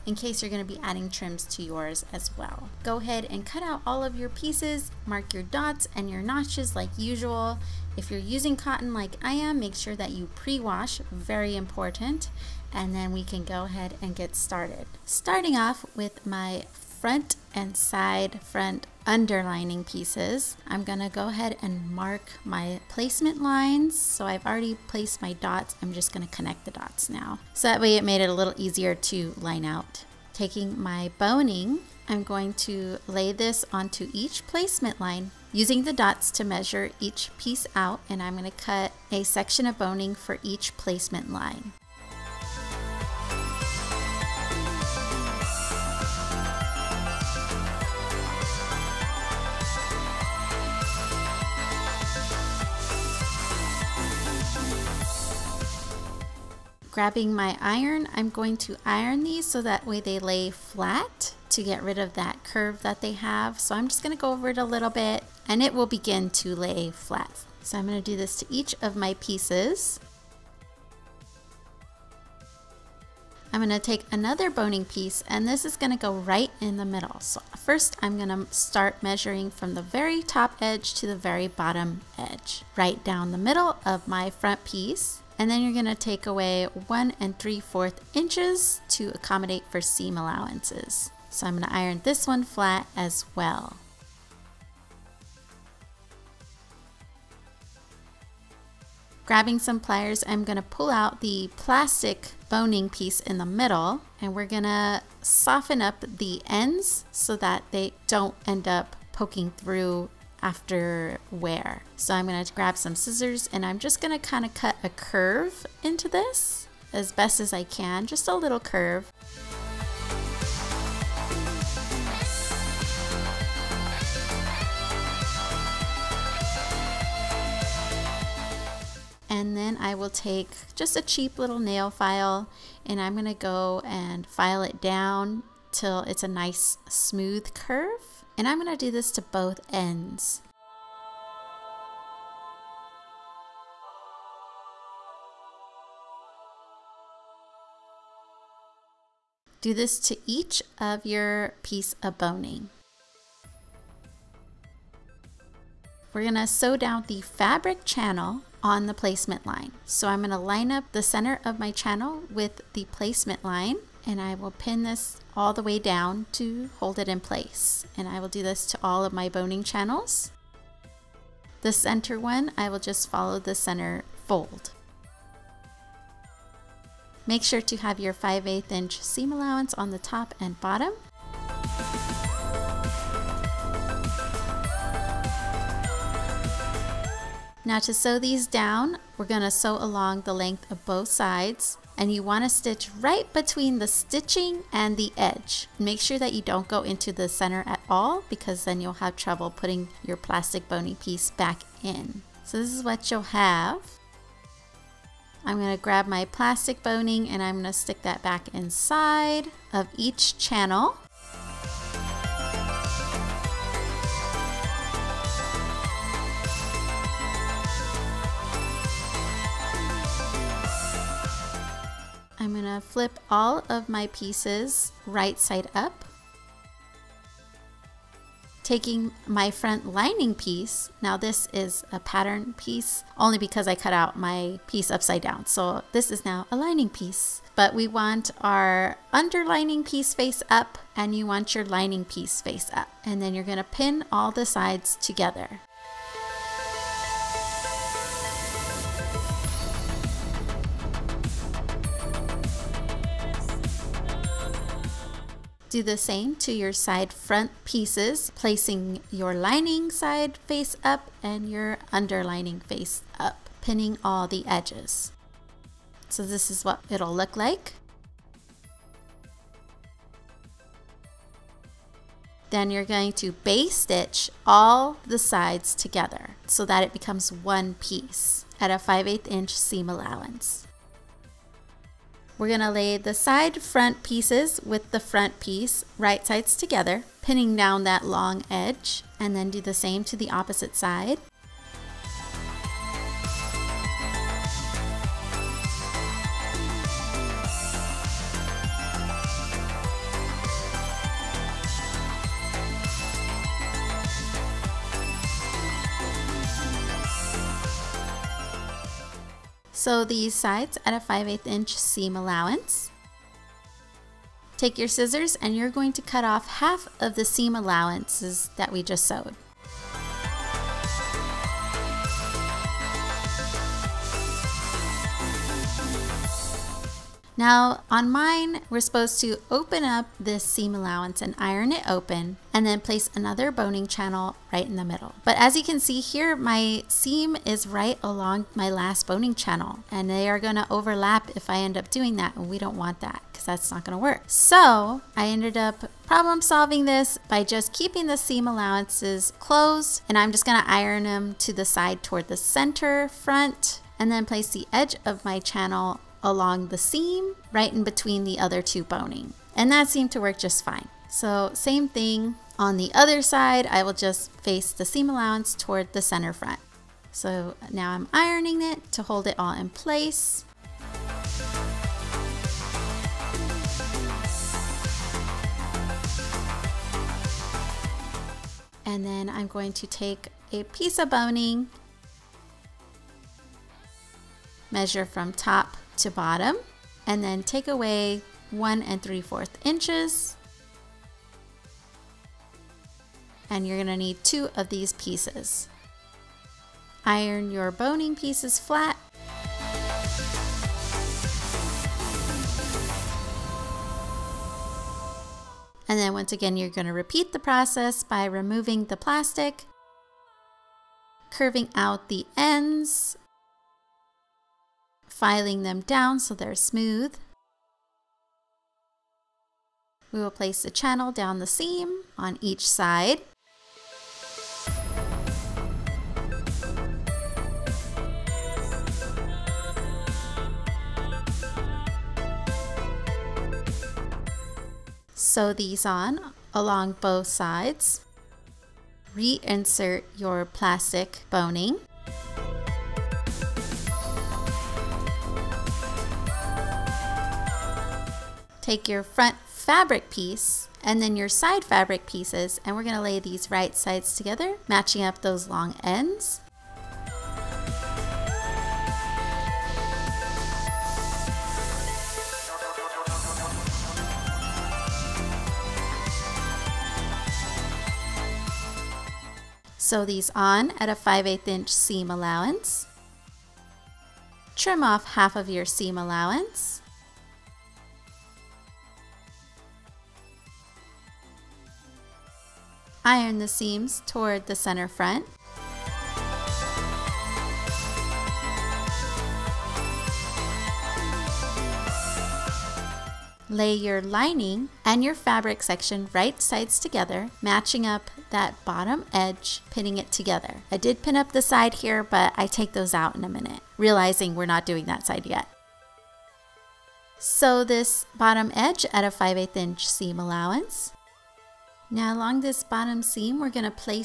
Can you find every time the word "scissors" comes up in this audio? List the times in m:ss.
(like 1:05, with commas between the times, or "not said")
1:52, 5:14.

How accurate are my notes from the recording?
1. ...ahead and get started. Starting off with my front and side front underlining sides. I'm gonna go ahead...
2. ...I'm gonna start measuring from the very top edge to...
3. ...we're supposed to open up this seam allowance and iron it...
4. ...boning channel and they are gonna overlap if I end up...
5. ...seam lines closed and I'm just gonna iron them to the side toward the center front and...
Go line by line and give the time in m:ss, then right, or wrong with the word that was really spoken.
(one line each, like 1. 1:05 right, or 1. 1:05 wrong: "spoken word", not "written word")
1. 0:13 wrong: "pieces", not "sides"
2. 1:18 right
3. 5:28 right
4. 5:39 right
5. 5:48 wrong: "allowances", not "lines".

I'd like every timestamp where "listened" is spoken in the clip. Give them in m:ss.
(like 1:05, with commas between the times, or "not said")
not said.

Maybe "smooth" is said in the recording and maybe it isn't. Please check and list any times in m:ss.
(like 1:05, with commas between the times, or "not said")
2:16, 6:56.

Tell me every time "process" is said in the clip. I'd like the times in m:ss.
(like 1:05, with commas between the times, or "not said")
6:47.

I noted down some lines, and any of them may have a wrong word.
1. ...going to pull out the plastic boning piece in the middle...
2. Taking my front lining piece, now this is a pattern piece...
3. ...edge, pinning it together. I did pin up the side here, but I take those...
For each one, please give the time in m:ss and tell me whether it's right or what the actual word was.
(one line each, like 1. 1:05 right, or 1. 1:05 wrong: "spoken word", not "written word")
1. 1:40 right
2. 3:48 right
3. 8:19 right.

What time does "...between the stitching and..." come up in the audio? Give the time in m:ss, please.
3:13.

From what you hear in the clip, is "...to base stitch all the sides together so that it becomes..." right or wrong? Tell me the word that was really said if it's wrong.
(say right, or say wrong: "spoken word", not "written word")
right.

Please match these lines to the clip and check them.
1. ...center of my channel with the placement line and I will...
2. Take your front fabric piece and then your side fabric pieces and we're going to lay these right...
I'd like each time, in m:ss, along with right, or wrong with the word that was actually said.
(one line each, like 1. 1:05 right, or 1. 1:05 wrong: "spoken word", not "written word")
1. 2:41 right
2. 7:28 right.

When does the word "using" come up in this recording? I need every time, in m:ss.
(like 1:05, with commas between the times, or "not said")
0:08, 0:35.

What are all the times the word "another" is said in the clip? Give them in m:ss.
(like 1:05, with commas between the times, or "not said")
1:14, 5:33.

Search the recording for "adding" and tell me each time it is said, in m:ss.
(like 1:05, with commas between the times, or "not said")
0:00.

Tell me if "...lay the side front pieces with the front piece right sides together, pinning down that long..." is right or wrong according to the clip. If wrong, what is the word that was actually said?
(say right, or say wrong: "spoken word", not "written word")
right.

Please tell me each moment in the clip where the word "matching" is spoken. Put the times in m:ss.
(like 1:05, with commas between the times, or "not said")
7:34, 8:17.